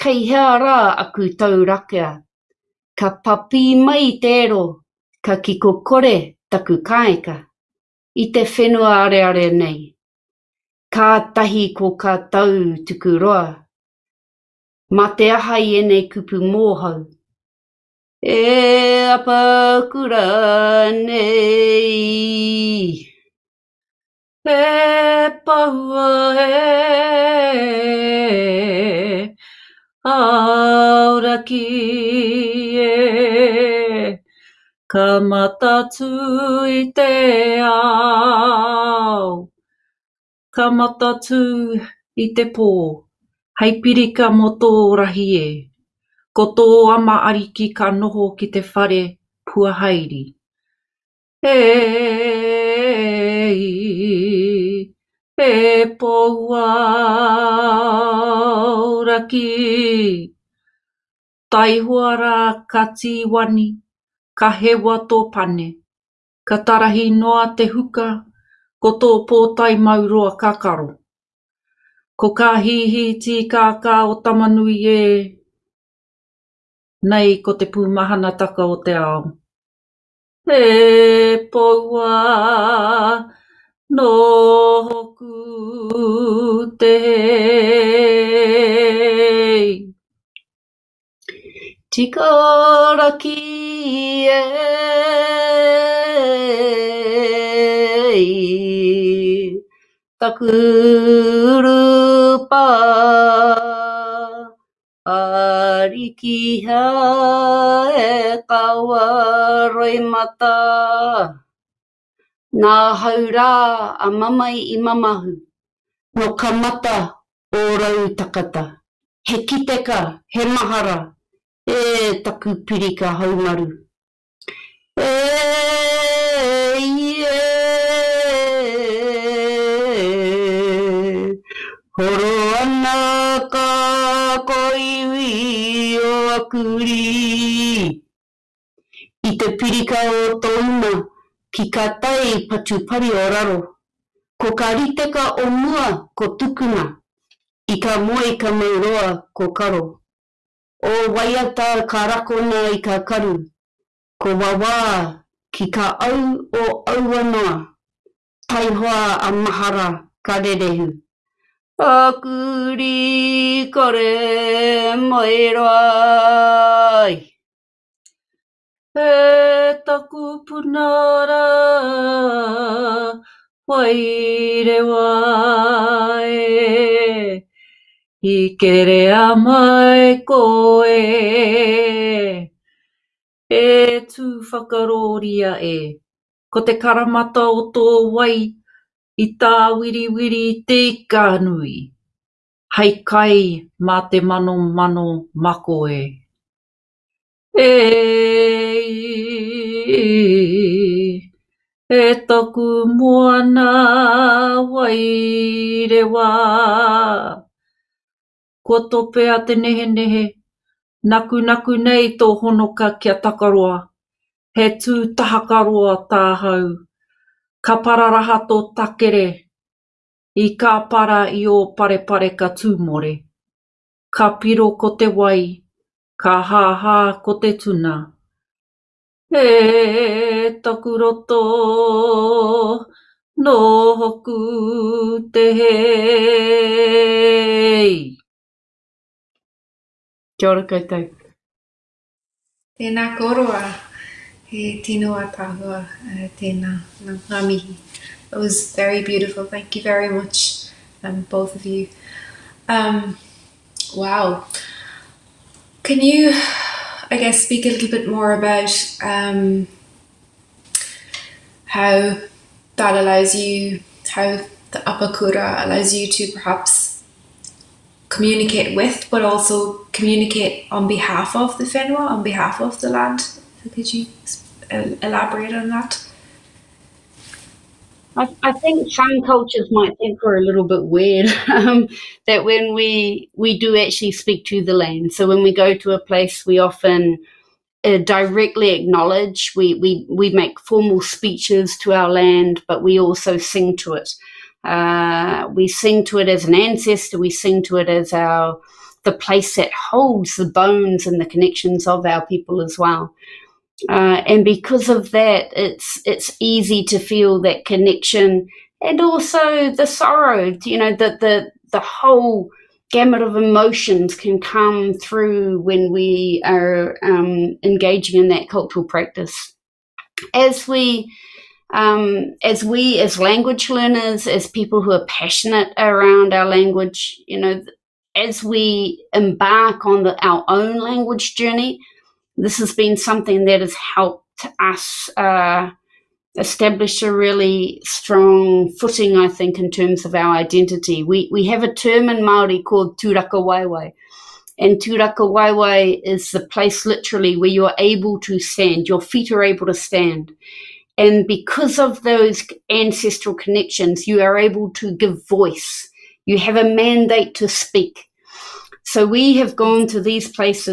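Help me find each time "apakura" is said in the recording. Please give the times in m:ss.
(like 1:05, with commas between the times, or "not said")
0:19, 4:24.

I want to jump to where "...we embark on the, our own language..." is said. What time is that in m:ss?
5:28.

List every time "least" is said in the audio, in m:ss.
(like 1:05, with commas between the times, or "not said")
not said.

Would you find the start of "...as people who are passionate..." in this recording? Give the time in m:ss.
5:24.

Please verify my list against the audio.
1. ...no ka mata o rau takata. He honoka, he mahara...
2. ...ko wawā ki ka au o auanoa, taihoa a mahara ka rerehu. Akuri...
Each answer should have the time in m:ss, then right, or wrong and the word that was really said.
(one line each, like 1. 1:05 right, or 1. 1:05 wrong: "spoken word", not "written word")
1. 1:56 wrong: "kiteka", not "honoka"
2. 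2:34 right.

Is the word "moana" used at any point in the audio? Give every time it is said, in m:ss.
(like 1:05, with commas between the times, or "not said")
3:22.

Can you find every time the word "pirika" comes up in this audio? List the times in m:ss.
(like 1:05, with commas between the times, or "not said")
0:43, 2:02, 2:19.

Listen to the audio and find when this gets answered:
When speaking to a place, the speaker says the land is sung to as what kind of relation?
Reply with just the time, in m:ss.
4:56.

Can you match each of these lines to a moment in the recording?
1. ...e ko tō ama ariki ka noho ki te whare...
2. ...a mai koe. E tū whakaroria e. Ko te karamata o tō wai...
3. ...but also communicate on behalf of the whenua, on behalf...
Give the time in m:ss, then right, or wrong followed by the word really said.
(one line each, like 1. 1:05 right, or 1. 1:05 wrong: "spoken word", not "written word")
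1. 0:45 right
2. 2:59 right
3. 4:29 right.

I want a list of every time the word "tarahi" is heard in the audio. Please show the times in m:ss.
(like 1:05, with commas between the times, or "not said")
1:06.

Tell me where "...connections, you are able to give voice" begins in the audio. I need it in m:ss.
5:53.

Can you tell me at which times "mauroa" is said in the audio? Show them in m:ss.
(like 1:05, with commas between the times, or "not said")
1:09, 2:28.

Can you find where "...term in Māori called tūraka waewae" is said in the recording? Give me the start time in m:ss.
5:41.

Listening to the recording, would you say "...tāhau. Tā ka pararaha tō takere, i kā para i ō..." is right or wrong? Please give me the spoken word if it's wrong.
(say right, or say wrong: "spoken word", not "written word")
right.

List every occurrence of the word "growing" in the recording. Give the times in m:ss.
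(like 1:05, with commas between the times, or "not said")
not said.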